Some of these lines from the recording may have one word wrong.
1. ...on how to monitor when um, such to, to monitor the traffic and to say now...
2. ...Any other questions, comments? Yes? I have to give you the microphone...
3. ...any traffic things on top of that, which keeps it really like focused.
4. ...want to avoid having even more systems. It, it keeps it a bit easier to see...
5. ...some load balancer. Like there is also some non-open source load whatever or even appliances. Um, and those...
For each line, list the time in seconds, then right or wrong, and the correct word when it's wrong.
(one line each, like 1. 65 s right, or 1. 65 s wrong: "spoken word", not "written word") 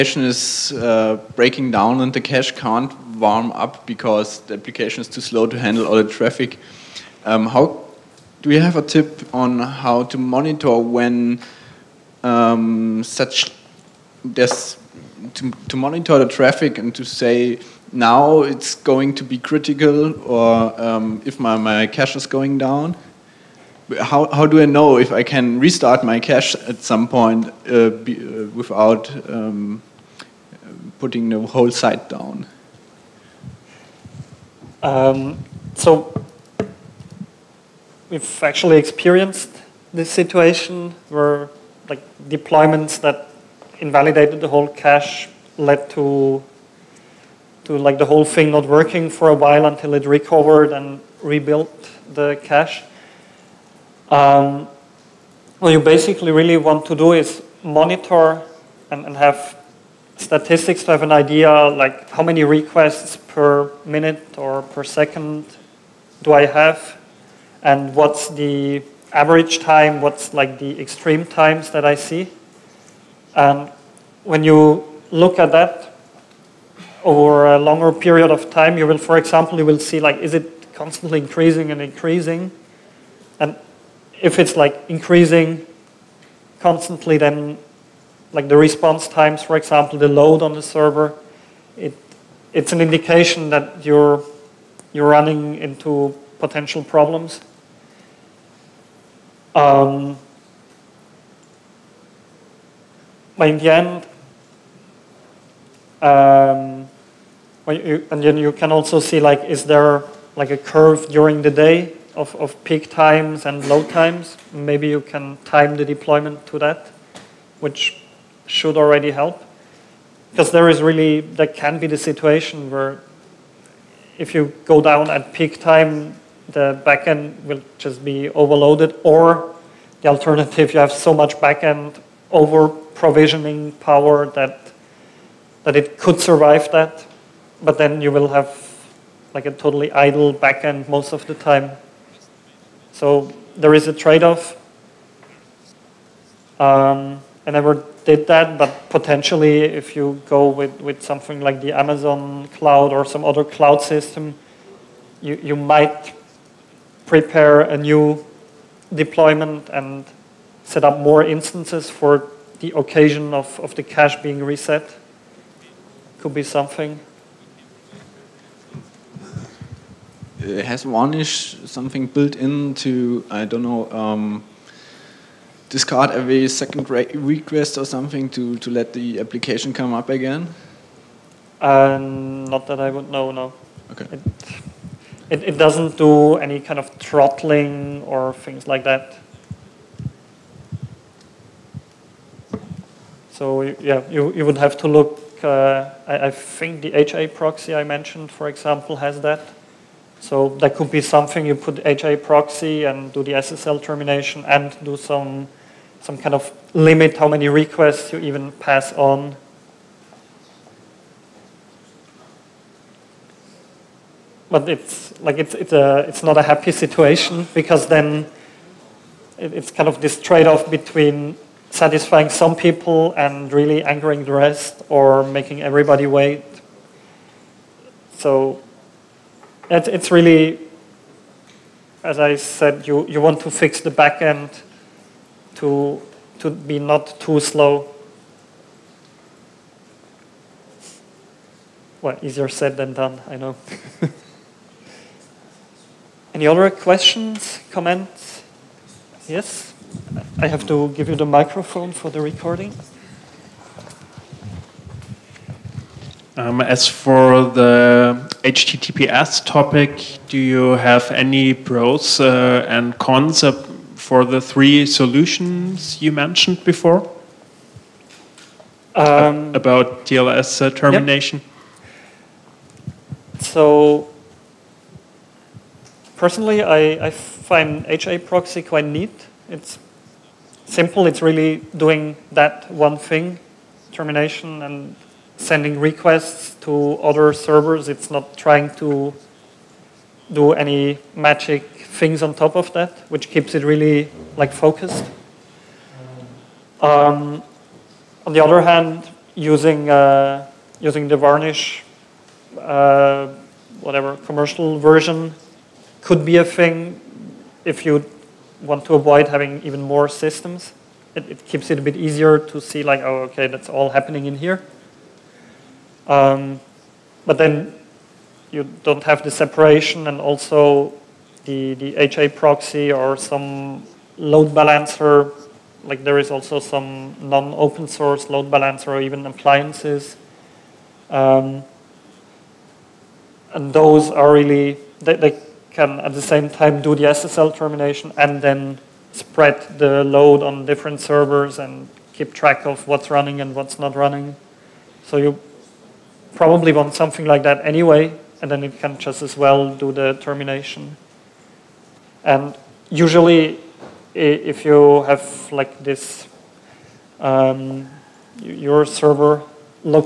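1. 9 s right
2. 246 s right
3. 290 s wrong: "magic", not "traffic"
4. 308 s right
5. 323 s wrong: "balancer", not "whatever".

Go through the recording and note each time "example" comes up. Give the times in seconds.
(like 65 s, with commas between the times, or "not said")
79 s, 89 s, 198 s.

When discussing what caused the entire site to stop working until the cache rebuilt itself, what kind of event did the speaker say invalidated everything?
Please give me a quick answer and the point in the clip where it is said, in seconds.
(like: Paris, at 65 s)
Deployments, at 42 s.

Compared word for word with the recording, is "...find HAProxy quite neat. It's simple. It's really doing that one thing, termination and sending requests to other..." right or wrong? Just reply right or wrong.
right.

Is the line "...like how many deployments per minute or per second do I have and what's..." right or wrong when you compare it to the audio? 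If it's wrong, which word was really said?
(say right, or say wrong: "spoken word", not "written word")
wrong: "requests", not "deployments".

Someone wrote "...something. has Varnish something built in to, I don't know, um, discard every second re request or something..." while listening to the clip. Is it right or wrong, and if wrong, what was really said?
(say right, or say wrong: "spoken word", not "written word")
right.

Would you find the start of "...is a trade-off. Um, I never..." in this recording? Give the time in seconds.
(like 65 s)
143 s.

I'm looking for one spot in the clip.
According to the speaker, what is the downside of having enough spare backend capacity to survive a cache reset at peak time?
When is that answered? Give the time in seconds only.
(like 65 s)
139 s.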